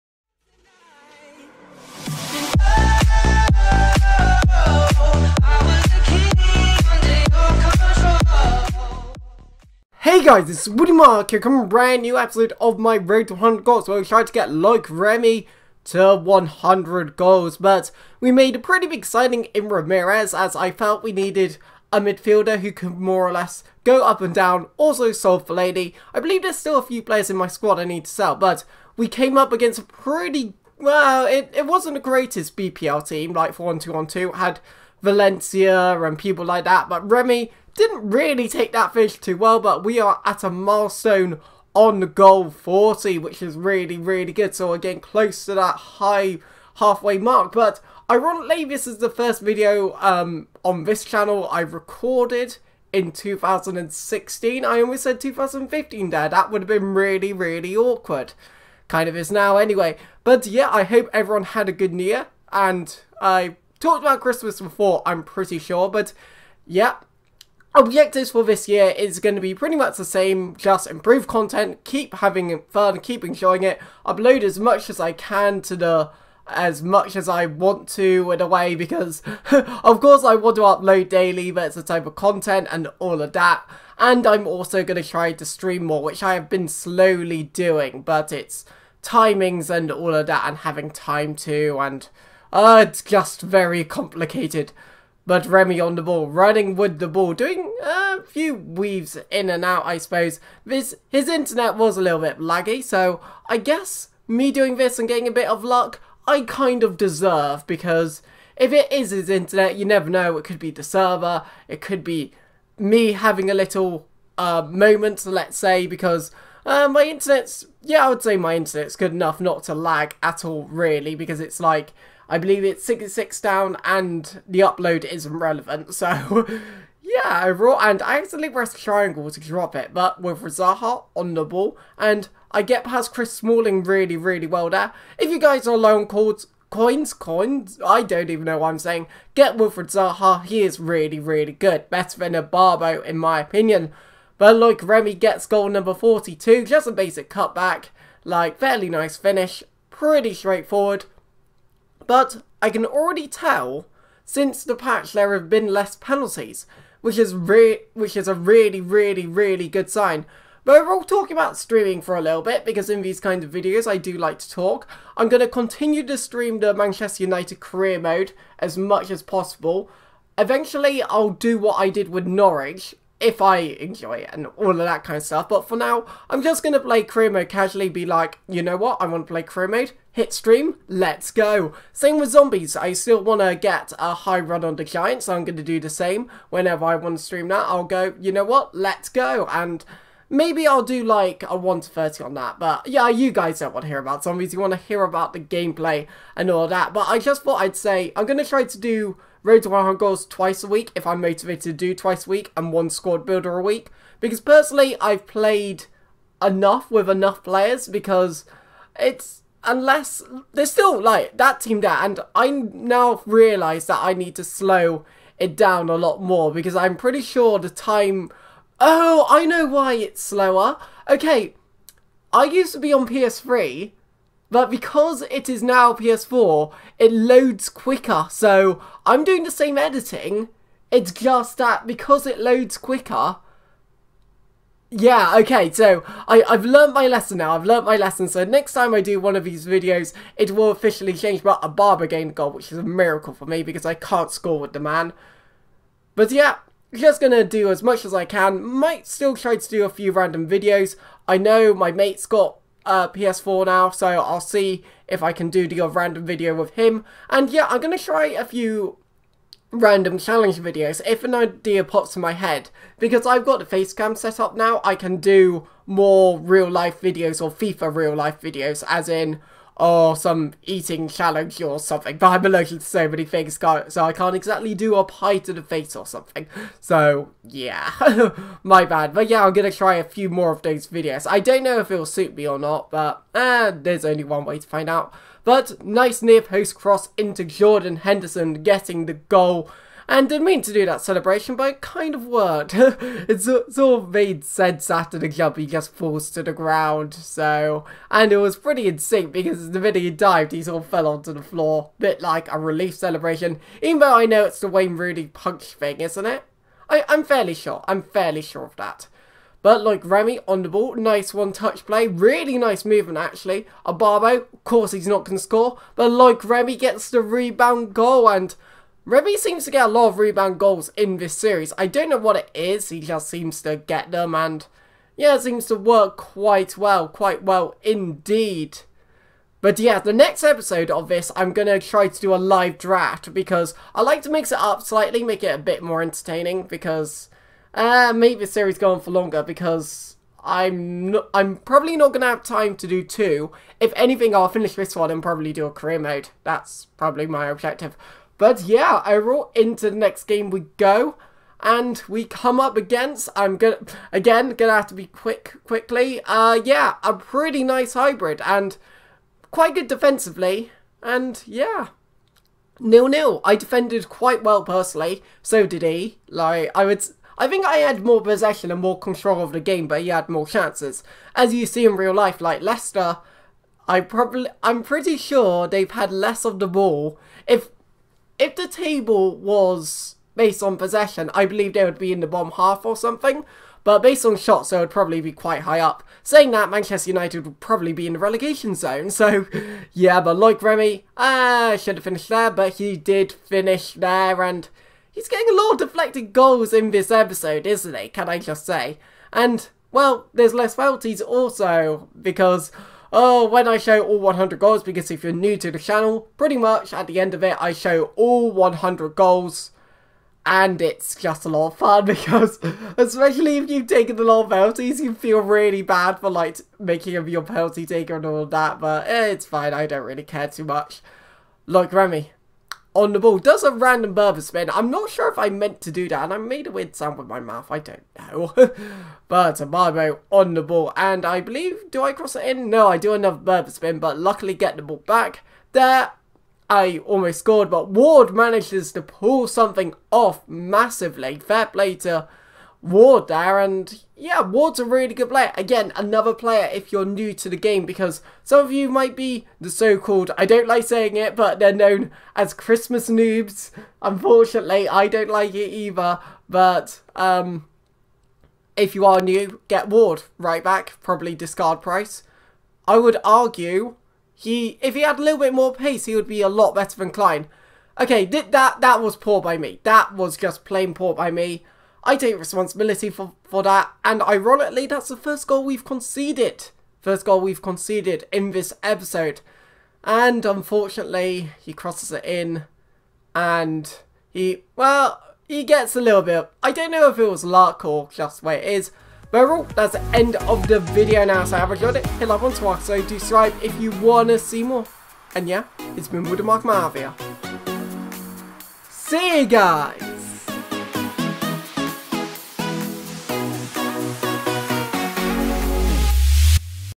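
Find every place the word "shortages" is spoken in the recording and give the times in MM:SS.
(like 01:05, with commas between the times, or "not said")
not said.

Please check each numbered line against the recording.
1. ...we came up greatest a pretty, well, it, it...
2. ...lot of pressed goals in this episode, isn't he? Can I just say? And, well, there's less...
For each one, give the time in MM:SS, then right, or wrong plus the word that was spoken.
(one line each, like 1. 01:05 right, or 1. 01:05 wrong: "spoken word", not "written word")
1. 00:28 wrong: "against", not "greatest"
2. 06:35 wrong: "deflected", not "pressed".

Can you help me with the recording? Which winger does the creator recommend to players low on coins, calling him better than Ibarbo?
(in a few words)
Wilfried Zaha.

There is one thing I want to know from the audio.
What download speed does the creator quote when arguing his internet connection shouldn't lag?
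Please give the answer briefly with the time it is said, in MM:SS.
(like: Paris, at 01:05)
66, at 02:02.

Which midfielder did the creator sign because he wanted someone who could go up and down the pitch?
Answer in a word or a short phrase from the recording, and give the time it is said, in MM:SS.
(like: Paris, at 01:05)
Ramirez, at 00:19.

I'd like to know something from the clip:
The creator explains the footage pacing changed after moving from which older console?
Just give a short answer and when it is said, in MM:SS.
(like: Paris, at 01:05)
PS3, at 03:43.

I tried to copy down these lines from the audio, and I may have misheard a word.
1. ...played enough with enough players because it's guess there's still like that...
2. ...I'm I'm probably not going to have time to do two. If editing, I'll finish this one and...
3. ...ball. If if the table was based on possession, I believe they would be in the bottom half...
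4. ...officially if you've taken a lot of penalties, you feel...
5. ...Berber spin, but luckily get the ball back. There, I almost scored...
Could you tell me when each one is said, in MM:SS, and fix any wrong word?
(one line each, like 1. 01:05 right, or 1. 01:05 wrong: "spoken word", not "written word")
1. 03:25 wrong: "unless", not "guess"
2. 05:40 wrong: "anything", not "editing"
3. 06:16 right
4. 06:52 wrong: "especially", not "officially"
5. 07:13 right.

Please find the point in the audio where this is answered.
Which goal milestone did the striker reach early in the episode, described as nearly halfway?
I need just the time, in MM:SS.
00:42.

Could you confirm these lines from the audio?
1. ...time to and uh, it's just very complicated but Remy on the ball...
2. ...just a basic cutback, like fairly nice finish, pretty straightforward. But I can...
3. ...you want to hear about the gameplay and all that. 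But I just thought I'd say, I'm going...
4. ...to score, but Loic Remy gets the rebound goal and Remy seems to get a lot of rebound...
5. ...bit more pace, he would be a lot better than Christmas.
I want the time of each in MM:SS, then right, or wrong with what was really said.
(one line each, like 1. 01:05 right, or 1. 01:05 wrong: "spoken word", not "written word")
1. 01:30 right
2. 02:26 right
3. 03:14 right
4. 05:15 right
5. 07:45 wrong: "Clyne", not "Christmas".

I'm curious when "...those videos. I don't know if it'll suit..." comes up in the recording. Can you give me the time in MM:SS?
04:40.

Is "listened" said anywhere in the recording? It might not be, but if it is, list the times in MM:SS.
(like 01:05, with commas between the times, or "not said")
not said.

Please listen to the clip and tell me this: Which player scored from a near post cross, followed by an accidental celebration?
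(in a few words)
Jordan Henderson.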